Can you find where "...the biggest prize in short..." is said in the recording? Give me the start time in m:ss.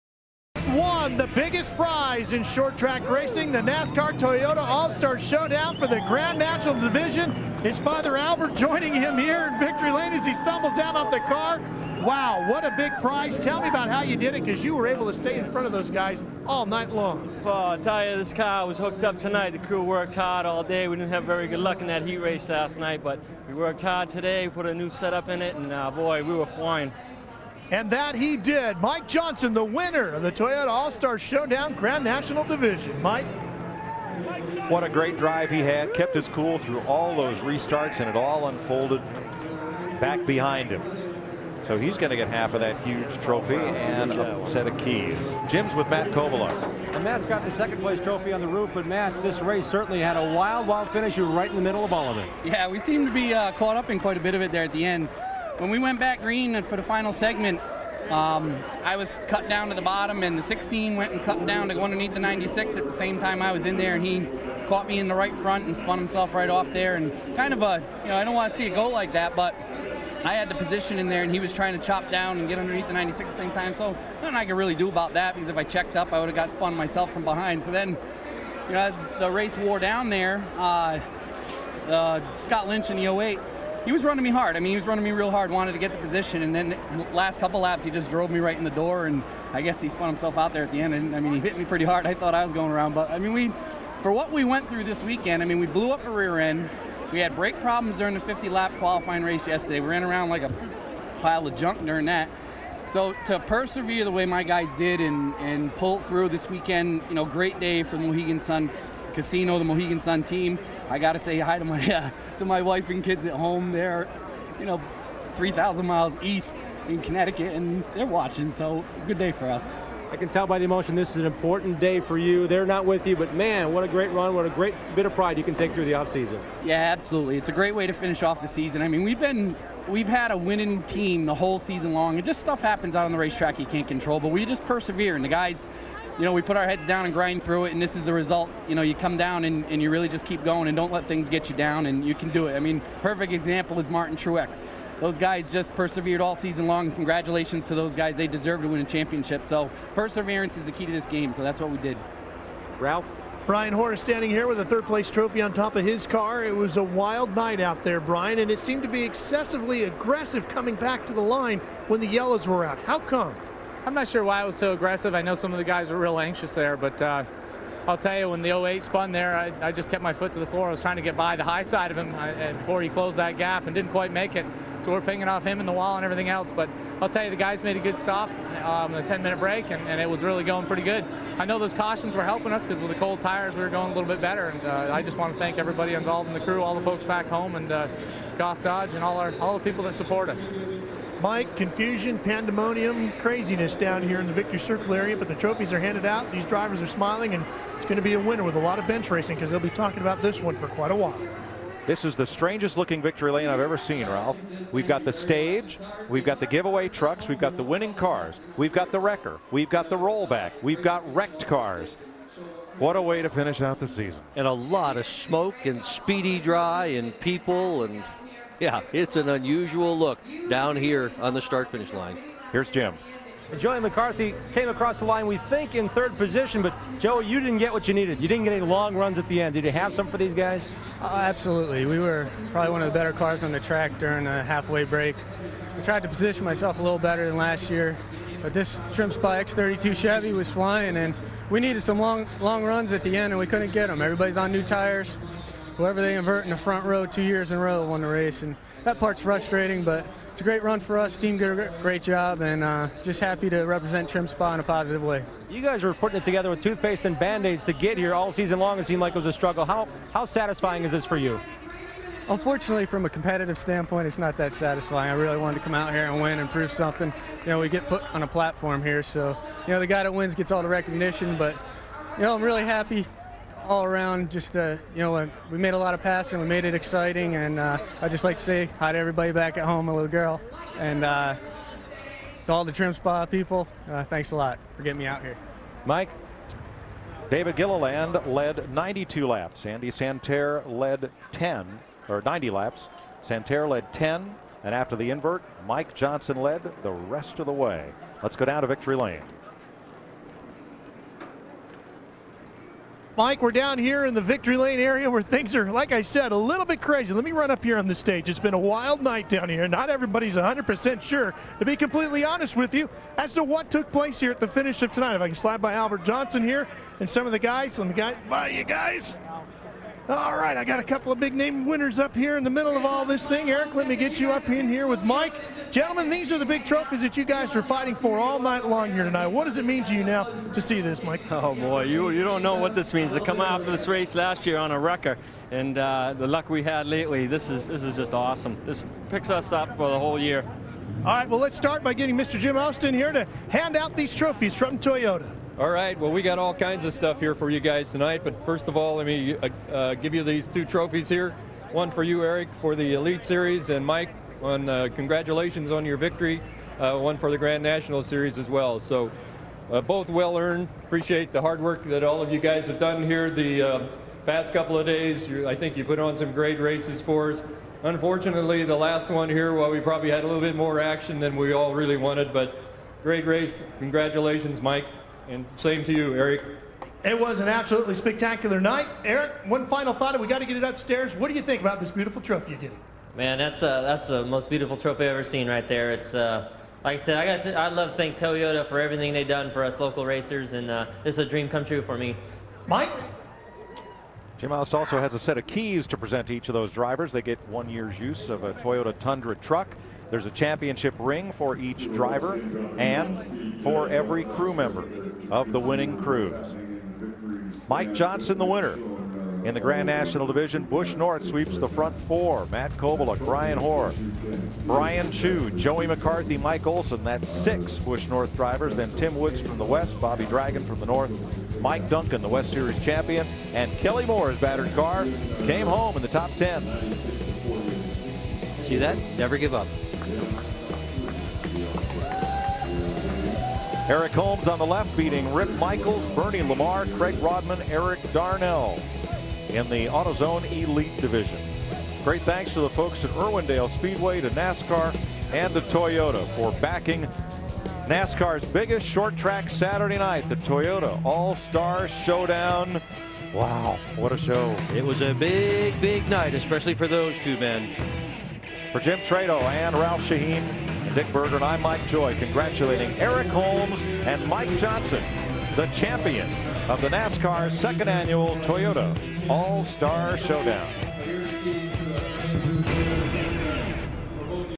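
0:01.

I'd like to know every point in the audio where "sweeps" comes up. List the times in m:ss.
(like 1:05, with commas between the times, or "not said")
6:51.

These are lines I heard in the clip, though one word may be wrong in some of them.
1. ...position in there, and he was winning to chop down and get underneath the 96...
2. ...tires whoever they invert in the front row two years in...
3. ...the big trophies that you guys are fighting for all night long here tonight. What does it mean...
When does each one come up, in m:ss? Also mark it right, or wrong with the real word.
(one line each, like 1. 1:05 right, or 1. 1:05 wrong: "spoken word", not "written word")
1. 1:10 wrong: "trying", not "winning"
2. 4:04 right
3. 5:26 right.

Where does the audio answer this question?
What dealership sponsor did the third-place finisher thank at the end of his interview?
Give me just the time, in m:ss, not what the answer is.
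3:08.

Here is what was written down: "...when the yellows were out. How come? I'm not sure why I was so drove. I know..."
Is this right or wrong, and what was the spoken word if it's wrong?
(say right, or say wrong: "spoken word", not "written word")
wrong: "aggressive", not "drove".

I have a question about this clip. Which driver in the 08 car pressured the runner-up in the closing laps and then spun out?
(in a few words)
Scott Lynch.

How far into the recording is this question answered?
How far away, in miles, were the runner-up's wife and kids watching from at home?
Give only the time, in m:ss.
1:55.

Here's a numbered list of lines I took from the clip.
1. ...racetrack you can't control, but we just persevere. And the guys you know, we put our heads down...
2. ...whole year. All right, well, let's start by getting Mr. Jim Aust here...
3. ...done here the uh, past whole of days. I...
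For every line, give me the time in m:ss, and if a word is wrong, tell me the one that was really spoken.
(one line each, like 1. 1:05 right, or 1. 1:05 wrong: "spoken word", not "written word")
1. 2:13 right
2. 5:39 right
3. 6:02 wrong: "couple", not "whole".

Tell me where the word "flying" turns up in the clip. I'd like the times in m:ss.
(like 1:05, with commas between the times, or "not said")
0:26, 4:00.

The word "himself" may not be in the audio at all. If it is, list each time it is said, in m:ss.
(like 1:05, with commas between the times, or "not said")
1:05, 1:30.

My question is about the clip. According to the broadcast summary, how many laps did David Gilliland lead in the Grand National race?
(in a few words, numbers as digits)
92.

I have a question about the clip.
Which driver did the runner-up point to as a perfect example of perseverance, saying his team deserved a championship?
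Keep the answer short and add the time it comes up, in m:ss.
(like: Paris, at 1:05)
Martin Truex, at 2:23.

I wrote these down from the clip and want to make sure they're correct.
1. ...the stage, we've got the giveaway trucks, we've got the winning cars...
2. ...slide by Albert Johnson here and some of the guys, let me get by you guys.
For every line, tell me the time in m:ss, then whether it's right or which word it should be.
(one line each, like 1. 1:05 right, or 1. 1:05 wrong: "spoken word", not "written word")
1. 3:25 right
2. 5:15 right.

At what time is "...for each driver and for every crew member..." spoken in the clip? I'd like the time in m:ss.
6:41.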